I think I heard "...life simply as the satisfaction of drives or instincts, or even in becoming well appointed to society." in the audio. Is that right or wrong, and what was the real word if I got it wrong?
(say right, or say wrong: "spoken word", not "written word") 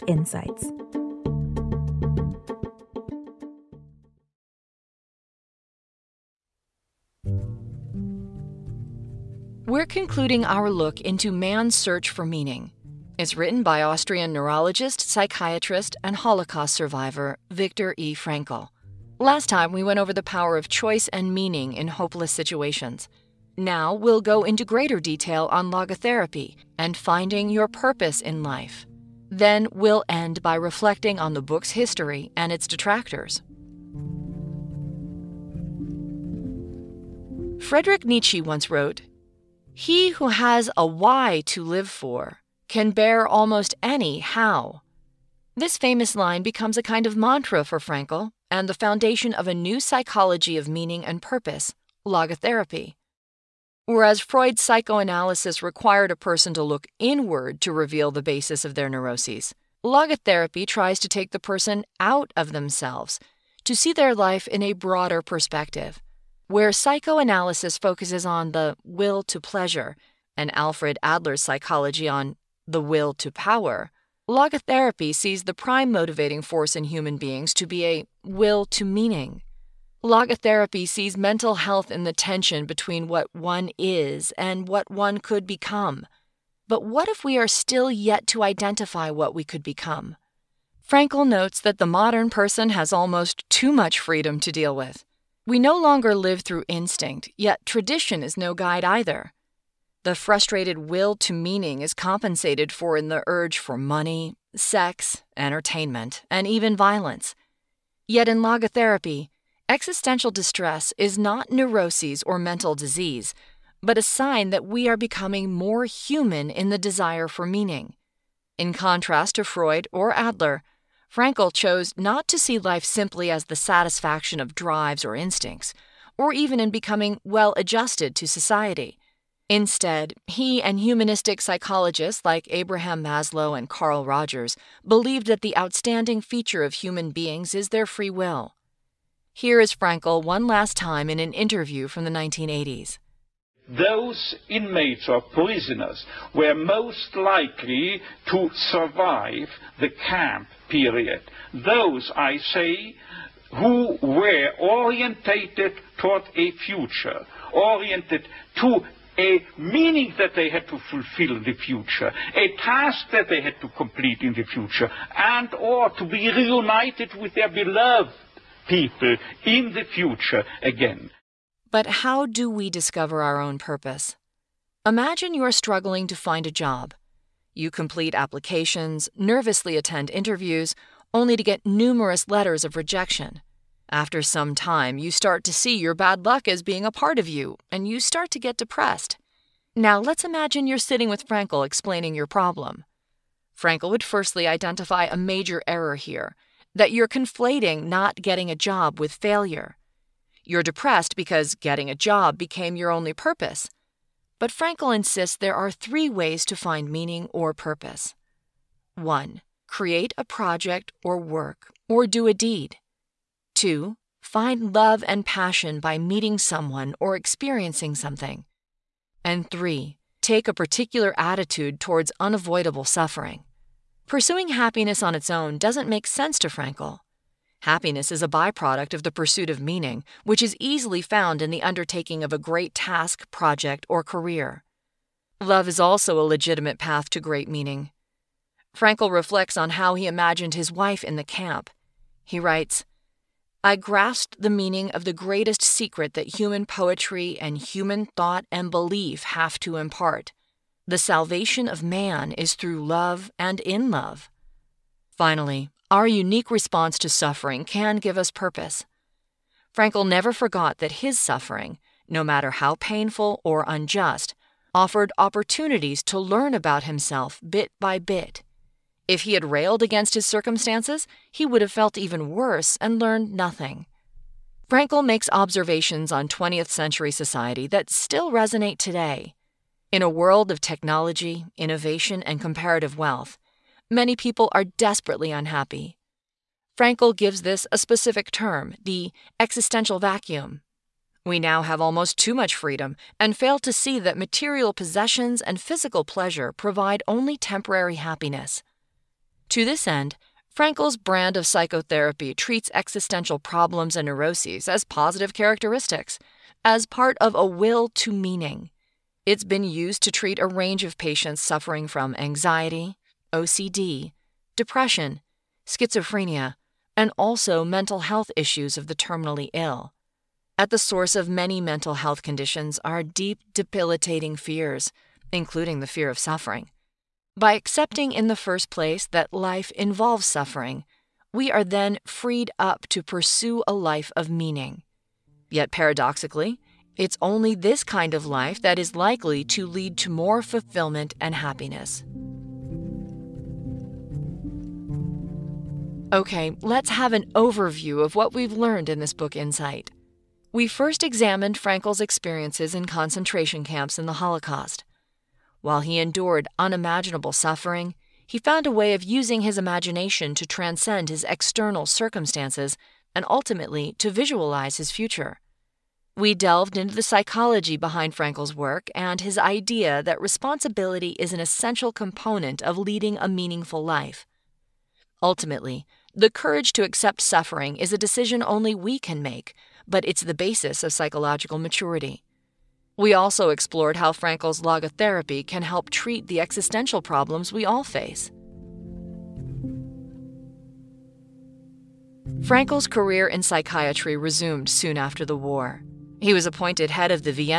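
wrong: "adjusted", not "appointed".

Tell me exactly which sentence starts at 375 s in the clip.
Ultimately, the courage to accept suffering is a decision only we can make, but it's the basis of psychological maturity.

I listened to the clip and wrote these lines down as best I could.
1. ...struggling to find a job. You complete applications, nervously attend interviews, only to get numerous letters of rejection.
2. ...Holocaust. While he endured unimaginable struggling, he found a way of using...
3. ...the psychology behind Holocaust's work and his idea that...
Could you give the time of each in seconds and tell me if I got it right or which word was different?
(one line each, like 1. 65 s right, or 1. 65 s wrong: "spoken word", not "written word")
1. 175 s right
2. 354 s wrong: "suffering", not "struggling"
3. 366 s wrong: "Frankl", not "Holocaust".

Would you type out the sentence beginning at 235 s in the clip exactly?
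Love is also a legitimate path to great meaning.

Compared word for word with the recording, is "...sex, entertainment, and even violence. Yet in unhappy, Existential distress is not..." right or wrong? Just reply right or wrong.
wrong.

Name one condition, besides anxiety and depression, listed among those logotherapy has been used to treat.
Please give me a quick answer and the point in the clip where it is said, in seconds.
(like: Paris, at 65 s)
OCD, at 313 s.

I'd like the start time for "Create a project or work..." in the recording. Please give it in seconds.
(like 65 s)
209 s.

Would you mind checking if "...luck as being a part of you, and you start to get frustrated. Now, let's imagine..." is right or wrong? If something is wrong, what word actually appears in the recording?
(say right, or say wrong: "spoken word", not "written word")
wrong: "depressed", not "frustrated".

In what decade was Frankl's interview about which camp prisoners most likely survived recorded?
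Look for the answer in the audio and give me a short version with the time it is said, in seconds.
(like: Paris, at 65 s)
1980s, at 142 s.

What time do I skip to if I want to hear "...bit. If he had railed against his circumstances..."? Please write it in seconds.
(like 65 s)
267 s.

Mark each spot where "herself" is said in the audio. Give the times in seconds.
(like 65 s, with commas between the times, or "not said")
not said.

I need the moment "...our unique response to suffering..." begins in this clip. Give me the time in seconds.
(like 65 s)
255 s.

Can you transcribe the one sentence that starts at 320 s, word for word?
At the source of many mental health conditions are deep, debilitating fears, including the fear of suffering.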